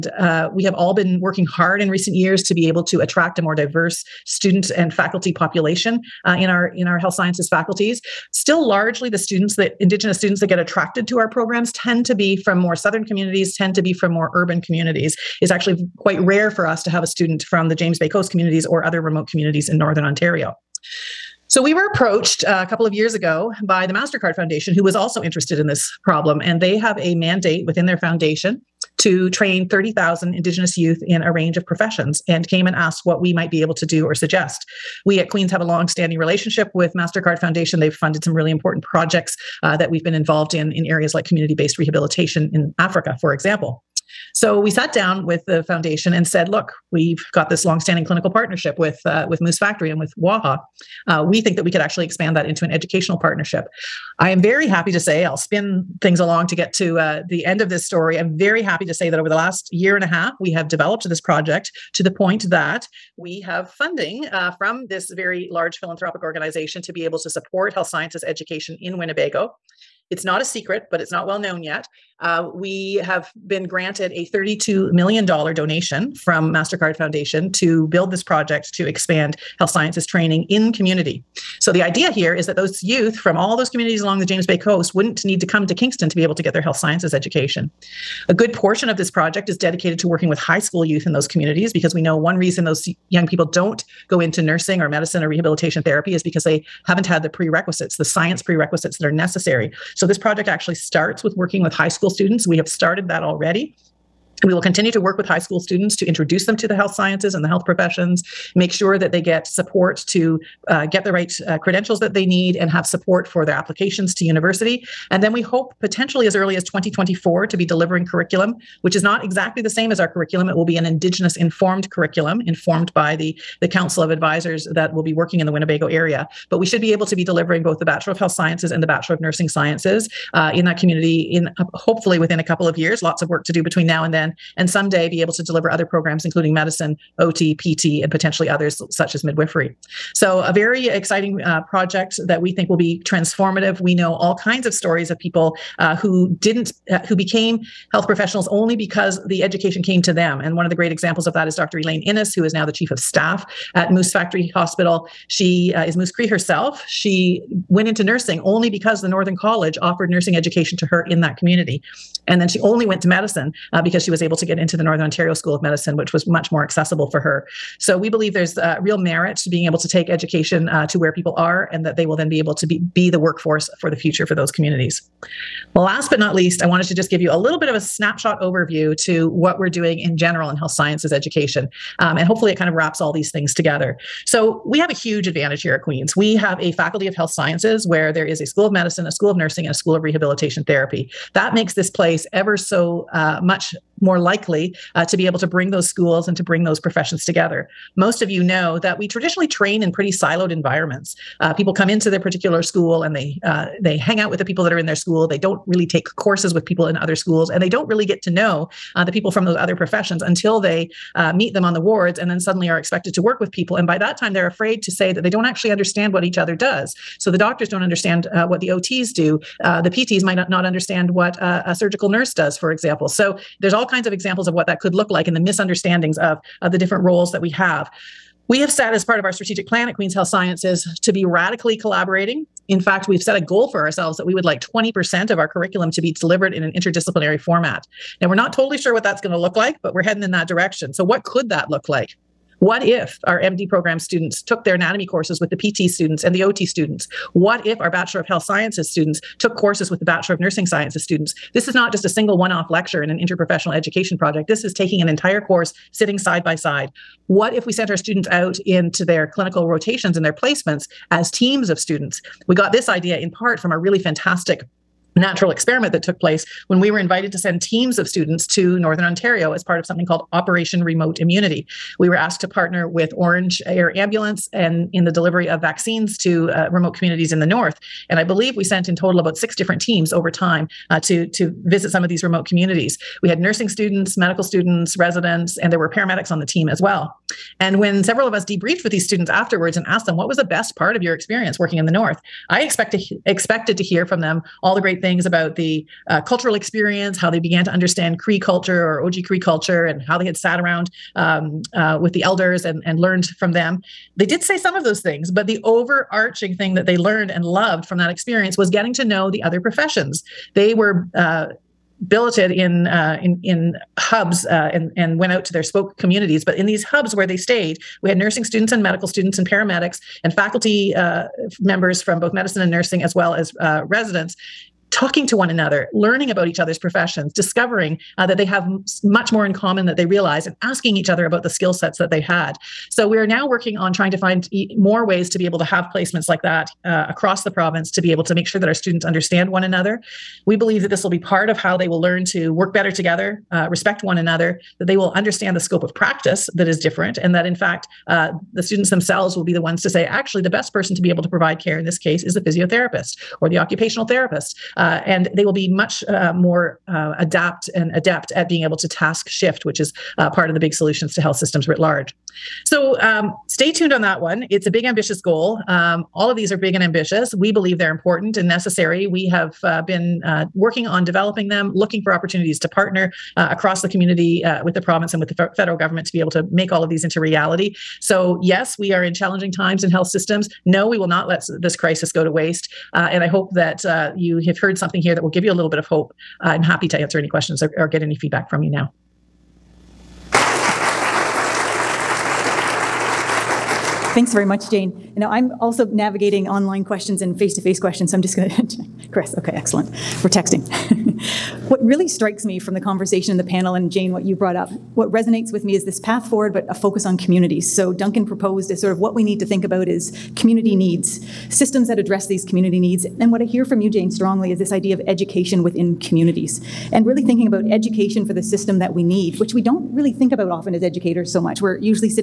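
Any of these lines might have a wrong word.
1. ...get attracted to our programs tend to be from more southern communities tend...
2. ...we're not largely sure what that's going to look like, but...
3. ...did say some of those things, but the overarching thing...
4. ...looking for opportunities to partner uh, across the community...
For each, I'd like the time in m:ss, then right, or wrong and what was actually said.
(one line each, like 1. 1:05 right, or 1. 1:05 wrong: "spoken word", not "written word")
1. 0:10 right
2. 3:58 wrong: "totally", not "largely"
3. 5:04 right
4. 6:11 right.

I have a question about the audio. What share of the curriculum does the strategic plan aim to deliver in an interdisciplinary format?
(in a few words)
20%.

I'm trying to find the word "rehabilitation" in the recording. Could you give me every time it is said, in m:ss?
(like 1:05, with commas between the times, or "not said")
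0:41, 1:35, 3:10.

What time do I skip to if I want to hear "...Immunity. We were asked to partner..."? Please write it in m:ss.
4:31.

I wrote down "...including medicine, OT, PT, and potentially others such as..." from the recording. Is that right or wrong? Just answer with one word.
right.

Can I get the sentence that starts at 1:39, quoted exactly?
So, this project actually starts with working with high school students.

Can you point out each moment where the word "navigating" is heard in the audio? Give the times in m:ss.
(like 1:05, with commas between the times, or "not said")
6:35.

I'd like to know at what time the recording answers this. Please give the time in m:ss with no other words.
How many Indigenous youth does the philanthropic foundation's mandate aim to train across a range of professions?
0:29.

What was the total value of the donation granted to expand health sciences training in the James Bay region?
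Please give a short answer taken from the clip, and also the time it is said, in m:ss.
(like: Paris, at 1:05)
$32 million, at 1:14.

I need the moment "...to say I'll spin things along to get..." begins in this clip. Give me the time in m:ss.
0:54.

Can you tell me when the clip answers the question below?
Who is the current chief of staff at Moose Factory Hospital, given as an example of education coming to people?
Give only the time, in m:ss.
2:31.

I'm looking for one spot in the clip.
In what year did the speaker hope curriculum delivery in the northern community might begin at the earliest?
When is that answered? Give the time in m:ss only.
1:56.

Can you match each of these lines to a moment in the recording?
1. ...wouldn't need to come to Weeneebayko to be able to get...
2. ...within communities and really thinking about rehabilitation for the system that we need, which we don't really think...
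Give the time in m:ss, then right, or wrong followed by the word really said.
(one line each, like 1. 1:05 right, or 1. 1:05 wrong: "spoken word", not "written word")
1. 1:24 wrong: "Kingston", not "Weeneebayko"
2. 6:55 wrong: "education", not "rehabilitation".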